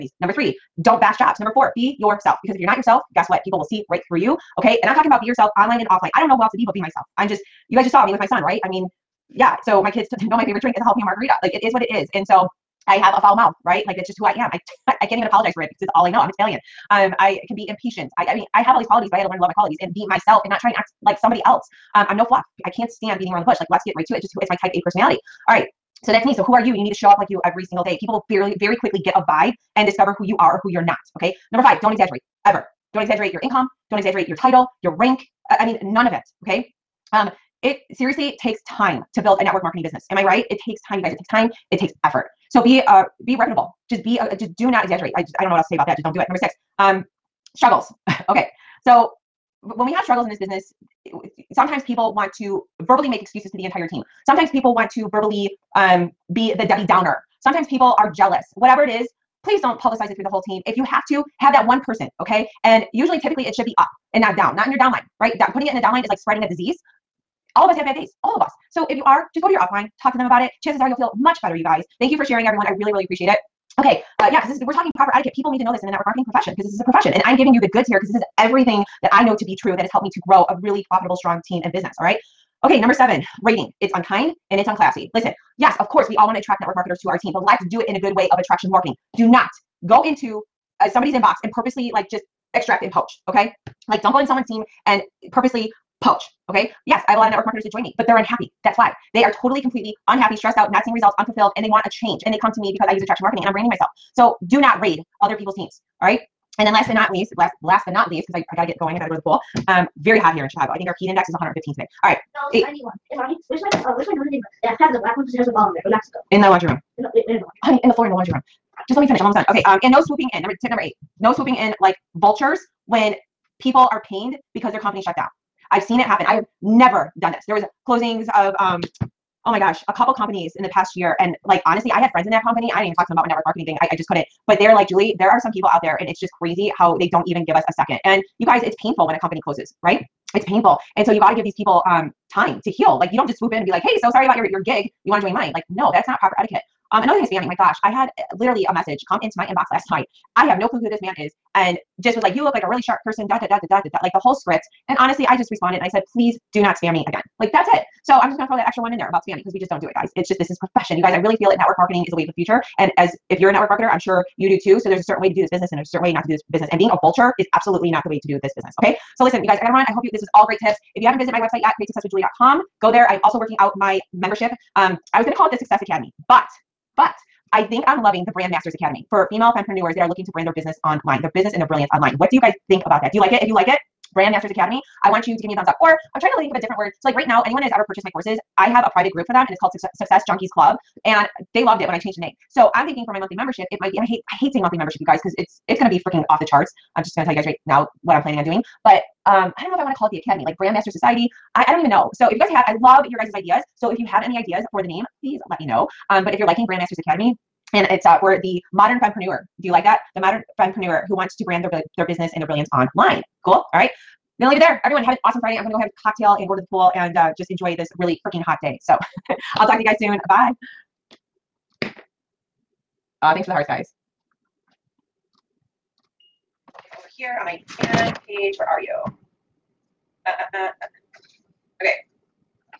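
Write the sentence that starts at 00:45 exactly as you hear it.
I just, I don't know what else to say about that.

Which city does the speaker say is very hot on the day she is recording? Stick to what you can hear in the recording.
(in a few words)
Chicago.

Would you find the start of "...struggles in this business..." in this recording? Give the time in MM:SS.
00:50.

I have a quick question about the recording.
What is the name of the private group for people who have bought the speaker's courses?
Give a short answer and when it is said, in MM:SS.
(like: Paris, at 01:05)
Success Junkies Club, at 03:09.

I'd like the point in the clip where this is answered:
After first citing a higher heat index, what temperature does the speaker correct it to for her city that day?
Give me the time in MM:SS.
01:52.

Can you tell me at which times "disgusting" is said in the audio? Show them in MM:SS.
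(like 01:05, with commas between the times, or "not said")
not said.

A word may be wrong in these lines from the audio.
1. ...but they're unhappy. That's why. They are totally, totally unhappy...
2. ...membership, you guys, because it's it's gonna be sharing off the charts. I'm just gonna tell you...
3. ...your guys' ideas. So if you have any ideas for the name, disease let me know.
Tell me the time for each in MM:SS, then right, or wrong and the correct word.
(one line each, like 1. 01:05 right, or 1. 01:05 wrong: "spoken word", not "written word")
1. 01:37 wrong: "completely", not "totally"
2. 03:14 wrong: "freaking", not "sharing"
3. 03:23 wrong: "please", not "disease".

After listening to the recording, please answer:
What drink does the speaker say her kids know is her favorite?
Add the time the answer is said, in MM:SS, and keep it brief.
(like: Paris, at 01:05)
jalapeno margarita, at 00:10.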